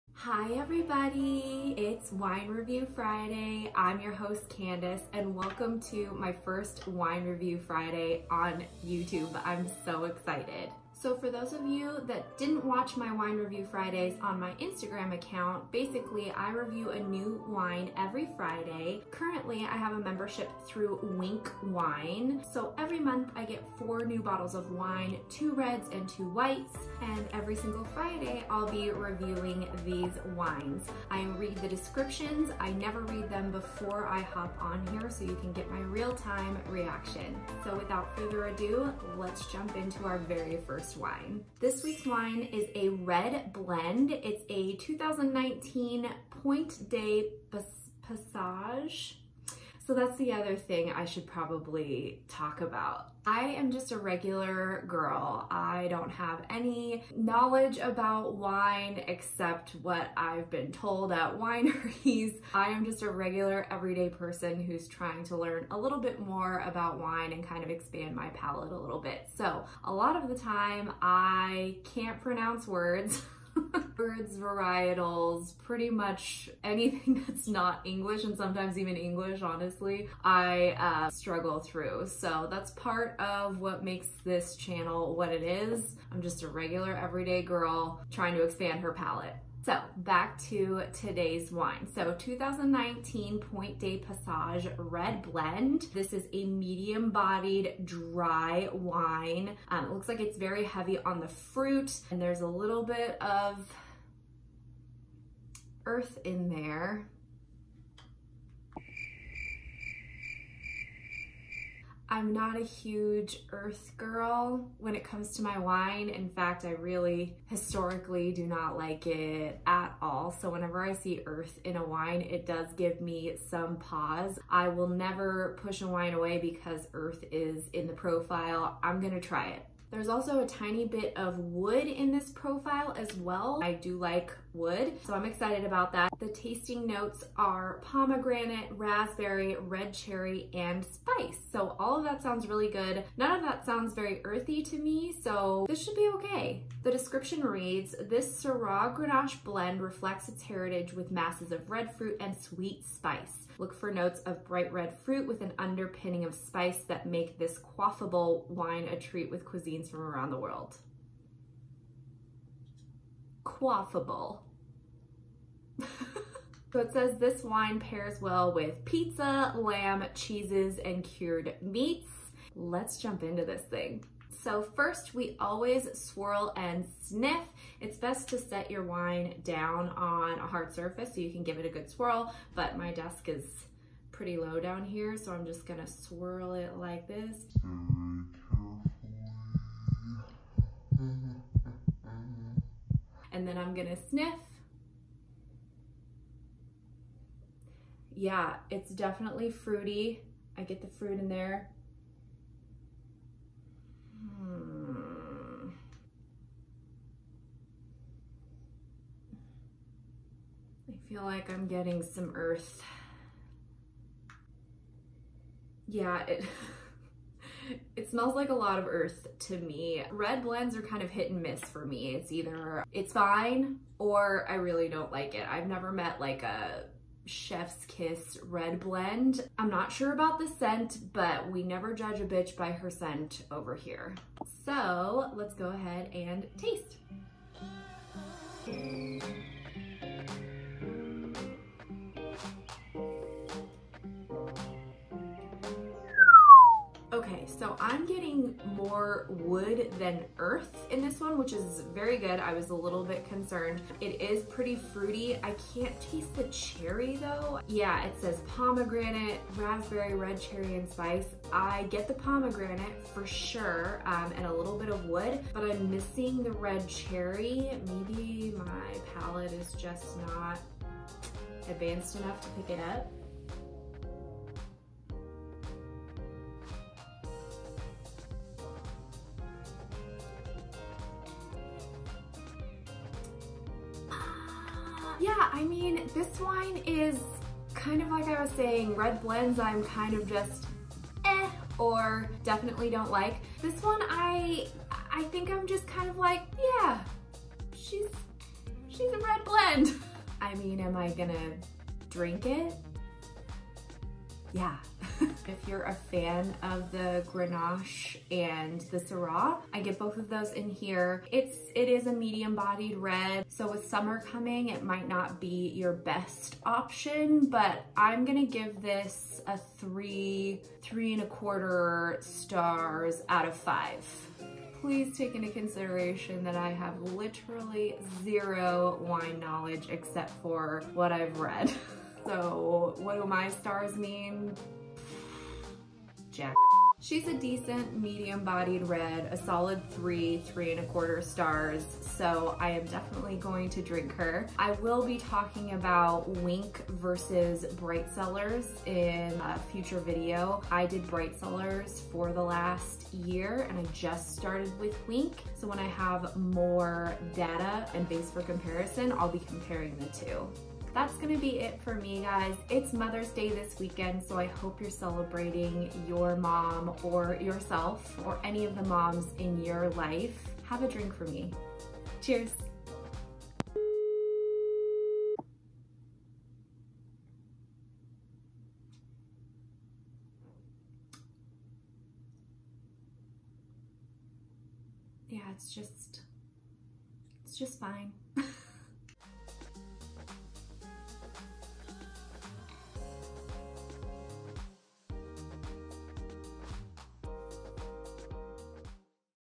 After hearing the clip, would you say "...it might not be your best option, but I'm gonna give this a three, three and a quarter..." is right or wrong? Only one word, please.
right.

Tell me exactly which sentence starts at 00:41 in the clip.
This week's wine is a red blend.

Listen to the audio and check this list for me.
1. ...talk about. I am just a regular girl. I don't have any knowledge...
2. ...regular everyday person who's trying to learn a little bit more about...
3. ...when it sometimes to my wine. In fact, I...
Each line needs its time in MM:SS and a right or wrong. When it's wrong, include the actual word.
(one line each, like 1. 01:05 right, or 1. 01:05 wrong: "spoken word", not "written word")
1. 00:52 right
2. 01:03 right
3. 01:54 wrong: "comes", not "sometimes".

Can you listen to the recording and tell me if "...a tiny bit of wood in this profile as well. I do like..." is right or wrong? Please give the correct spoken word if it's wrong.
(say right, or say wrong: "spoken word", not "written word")
right.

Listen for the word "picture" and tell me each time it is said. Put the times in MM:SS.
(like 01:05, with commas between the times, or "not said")
not said.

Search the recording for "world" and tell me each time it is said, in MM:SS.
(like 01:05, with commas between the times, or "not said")
02:40.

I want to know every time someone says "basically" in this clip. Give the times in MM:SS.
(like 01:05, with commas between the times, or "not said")
00:15.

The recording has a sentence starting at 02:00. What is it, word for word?
So whenever I see earth in a wine, it does give me some pause.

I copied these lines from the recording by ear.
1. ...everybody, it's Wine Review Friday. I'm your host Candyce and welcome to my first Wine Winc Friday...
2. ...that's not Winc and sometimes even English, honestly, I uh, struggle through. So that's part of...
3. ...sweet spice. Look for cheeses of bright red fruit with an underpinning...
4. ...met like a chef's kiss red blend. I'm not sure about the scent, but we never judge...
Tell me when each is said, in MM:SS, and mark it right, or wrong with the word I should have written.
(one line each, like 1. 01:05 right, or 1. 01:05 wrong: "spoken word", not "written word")
1. 00:00 wrong: "Review", not "Winc"
2. 01:17 wrong: "English", not "Winc"
3. 02:32 wrong: "notes", not "cheeses"
4. 03:45 right.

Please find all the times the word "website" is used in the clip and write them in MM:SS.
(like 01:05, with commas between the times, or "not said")
not said.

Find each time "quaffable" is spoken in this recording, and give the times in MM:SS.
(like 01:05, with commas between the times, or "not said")
02:37, 02:43.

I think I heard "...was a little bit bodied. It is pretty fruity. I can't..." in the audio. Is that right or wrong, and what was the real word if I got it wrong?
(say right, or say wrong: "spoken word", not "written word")
wrong: "concerned", not "bodied".